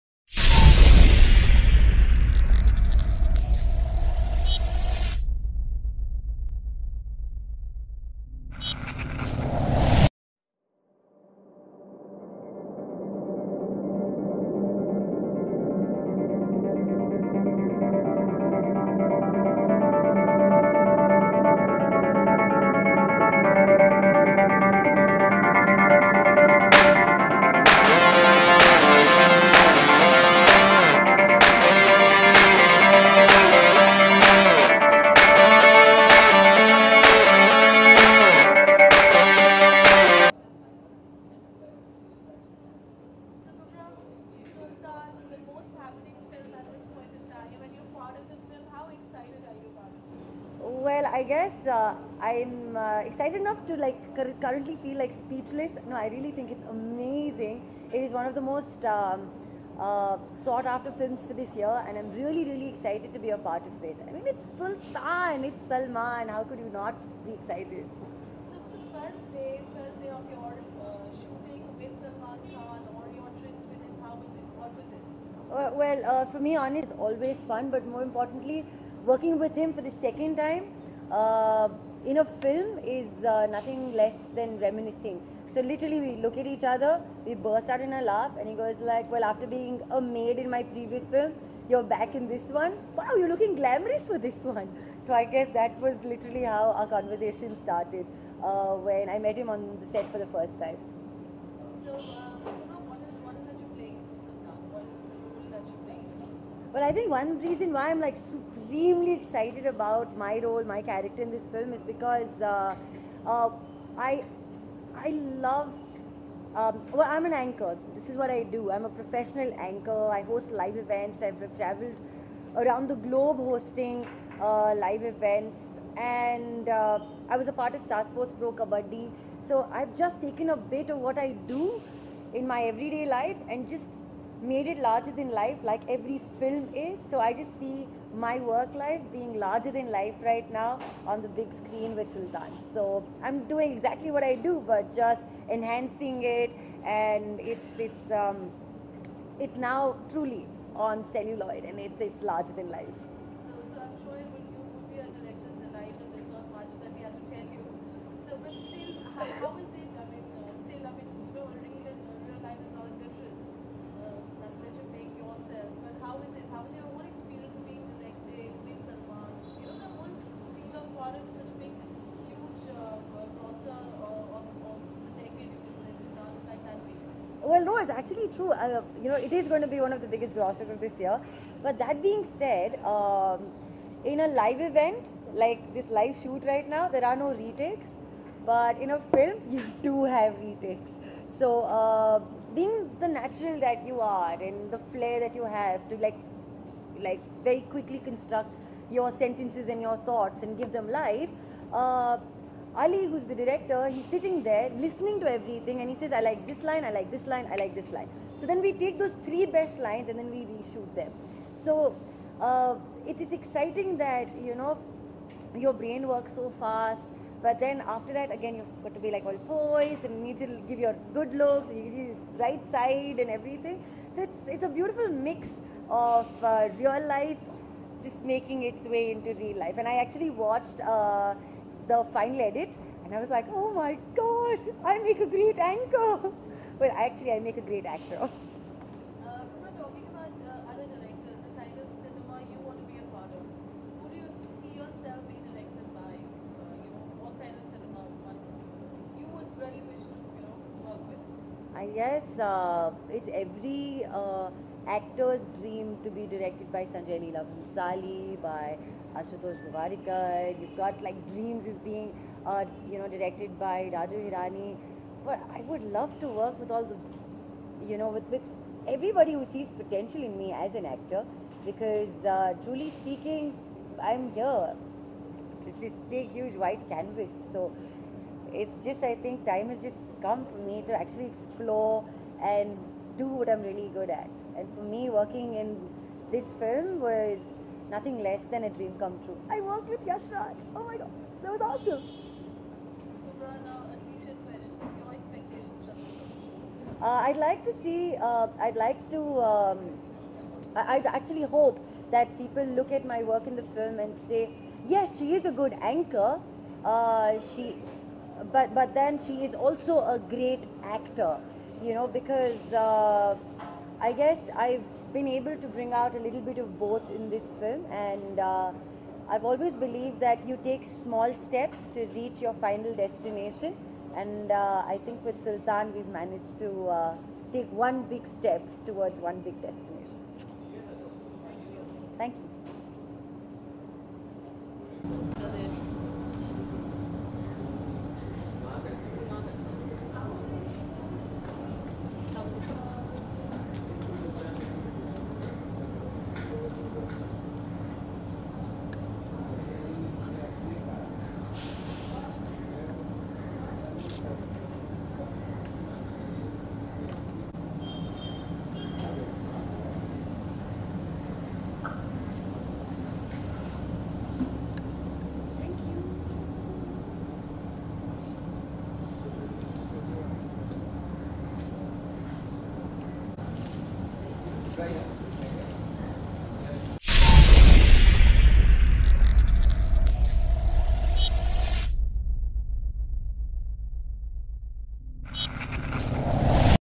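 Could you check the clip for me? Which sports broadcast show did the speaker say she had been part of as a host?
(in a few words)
Star Sports Pro Kabaddi.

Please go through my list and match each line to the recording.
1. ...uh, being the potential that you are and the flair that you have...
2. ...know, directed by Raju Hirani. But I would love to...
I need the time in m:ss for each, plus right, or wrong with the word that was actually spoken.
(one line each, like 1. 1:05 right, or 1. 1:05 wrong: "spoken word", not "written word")
1. 3:11 wrong: "natural", not "potential"
2. 4:22 right.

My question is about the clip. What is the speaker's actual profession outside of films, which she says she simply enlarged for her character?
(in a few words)
Professional anchor.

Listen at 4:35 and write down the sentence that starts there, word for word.
It's this big, huge white canvas.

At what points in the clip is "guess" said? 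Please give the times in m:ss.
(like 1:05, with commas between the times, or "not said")
0:51, 1:35, 4:11, 5:14.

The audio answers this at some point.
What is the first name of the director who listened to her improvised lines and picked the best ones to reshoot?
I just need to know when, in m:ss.
3:22.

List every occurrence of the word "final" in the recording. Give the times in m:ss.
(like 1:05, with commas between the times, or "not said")
3:52, 5:22.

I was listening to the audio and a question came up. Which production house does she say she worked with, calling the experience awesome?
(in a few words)
Yash Raj.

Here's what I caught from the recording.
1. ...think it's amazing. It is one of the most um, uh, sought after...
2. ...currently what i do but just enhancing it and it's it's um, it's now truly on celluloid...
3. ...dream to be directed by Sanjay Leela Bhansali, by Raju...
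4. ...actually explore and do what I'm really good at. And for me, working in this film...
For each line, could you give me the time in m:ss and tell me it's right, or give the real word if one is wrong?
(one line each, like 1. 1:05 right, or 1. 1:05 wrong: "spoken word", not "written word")
1. 0:56 right
2. 2:23 wrong: "exactly", not "currently"
3. 4:15 wrong: "Ashutosh", not "Raju"
4. 4:40 right.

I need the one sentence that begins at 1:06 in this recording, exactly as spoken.
How could you not be excited?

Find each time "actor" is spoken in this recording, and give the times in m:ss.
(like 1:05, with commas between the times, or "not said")
3:57, 4:14, 4:30, 5:10.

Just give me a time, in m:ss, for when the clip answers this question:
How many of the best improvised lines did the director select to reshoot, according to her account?
3:29.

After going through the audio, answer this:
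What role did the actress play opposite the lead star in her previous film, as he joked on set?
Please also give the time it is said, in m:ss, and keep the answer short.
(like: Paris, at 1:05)
A maid, at 1:29.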